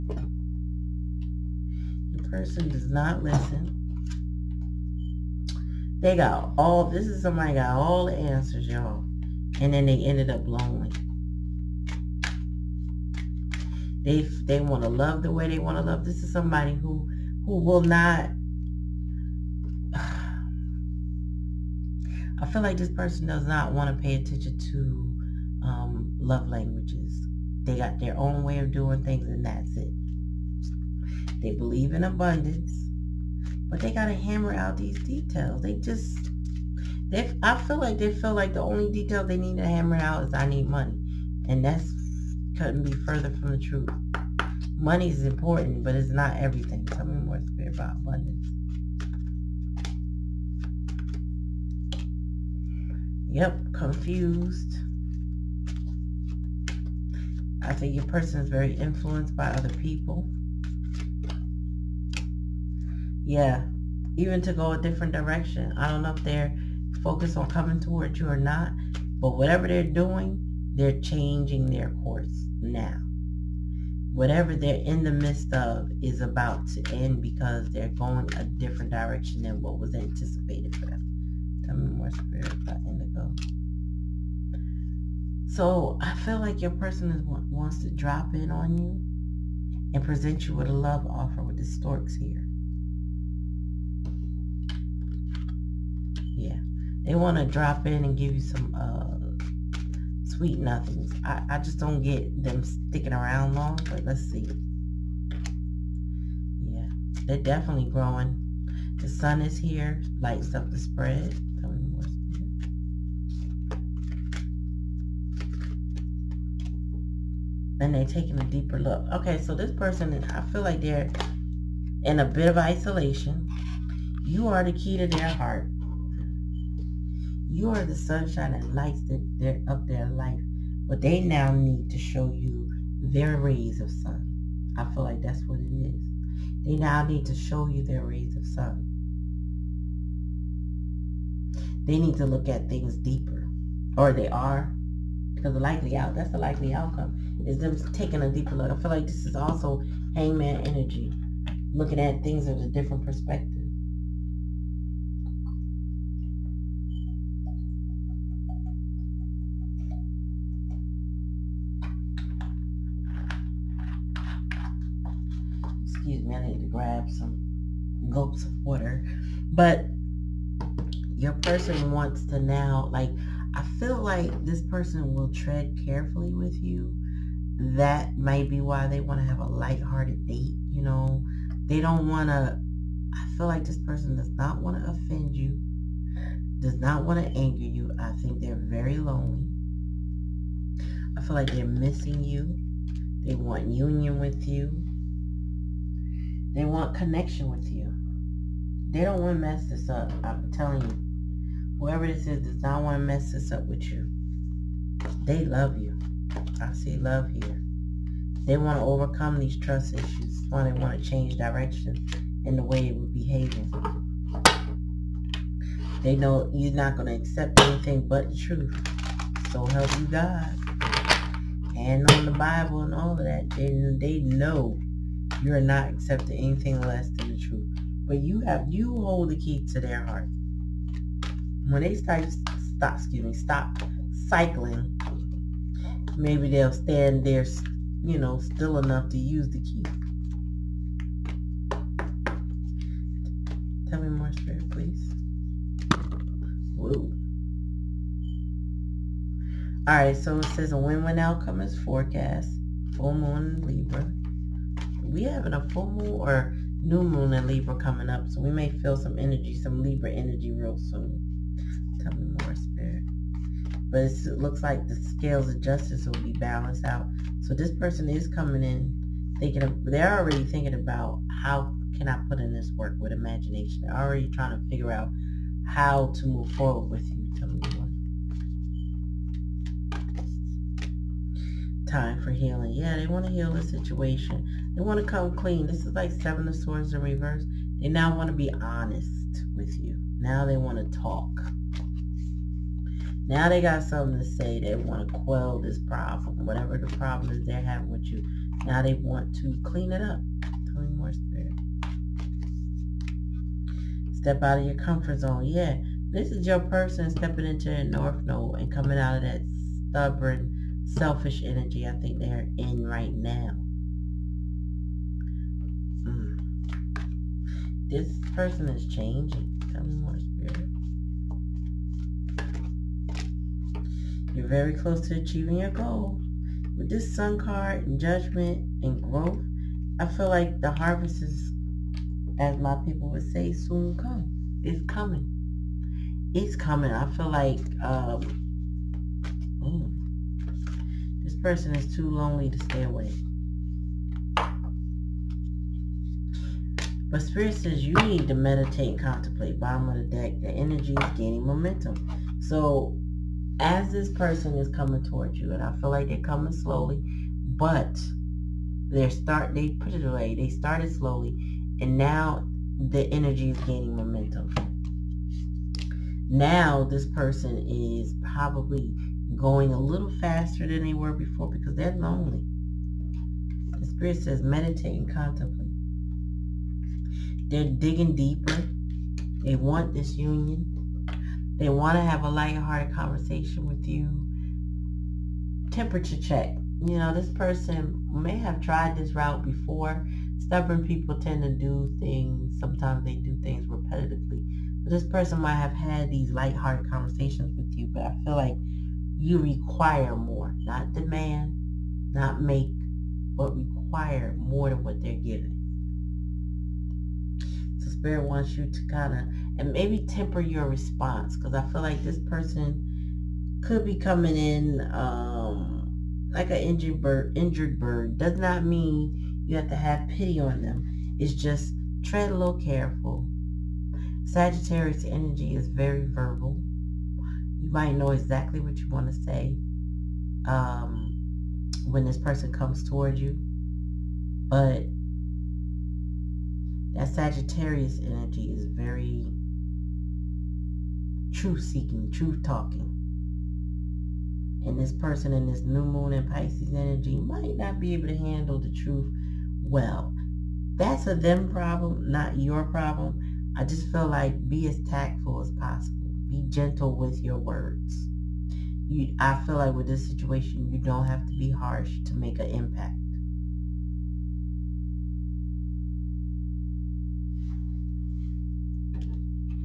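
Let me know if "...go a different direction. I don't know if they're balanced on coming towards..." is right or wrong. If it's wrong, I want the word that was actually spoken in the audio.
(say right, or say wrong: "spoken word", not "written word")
wrong: "focused", not "balanced".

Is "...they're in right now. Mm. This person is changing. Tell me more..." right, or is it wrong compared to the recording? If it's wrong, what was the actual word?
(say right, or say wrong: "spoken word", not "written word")
right.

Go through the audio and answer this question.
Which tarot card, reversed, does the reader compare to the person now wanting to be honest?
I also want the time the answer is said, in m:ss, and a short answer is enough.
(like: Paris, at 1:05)
Seven of Swords, at 4:46.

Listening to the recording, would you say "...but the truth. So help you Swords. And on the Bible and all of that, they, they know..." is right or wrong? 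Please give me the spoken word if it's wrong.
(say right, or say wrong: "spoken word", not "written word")
wrong: "God", not "Swords".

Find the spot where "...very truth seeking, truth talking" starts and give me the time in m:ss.
7:18.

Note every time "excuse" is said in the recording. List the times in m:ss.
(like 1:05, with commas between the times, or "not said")
2:46, 3:52.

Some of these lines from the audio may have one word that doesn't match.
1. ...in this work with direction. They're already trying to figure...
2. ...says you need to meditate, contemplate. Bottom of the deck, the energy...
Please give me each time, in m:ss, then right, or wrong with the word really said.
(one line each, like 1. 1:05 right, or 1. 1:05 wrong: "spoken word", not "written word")
1. 4:32 wrong: "imagination", not "direction"
2. 5:47 right.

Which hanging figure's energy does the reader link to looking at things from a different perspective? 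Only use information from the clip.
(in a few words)
Hangman.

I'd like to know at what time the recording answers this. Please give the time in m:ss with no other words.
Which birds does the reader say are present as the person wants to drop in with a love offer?
1:31.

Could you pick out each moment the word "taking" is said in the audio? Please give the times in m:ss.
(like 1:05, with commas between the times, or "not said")
1:58, 2:27.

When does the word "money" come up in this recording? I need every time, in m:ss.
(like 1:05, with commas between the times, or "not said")
0:40, 0:44.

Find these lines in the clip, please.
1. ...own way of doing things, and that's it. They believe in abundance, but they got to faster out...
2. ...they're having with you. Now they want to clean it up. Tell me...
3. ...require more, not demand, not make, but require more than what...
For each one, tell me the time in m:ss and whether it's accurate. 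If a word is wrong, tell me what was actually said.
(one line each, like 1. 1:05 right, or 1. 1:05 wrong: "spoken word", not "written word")
1. 0:28 wrong: "hammer", not "faster"
2. 4:57 right
3. 6:39 right.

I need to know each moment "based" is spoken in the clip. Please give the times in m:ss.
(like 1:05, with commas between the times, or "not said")
not said.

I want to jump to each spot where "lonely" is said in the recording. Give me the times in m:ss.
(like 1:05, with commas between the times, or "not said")
0:10, 3:08, 5:42, 6:11.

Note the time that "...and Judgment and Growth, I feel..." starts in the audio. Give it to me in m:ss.
5:27.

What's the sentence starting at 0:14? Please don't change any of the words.
They, they want to love the way they want to love.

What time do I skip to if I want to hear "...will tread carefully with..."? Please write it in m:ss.
2:55.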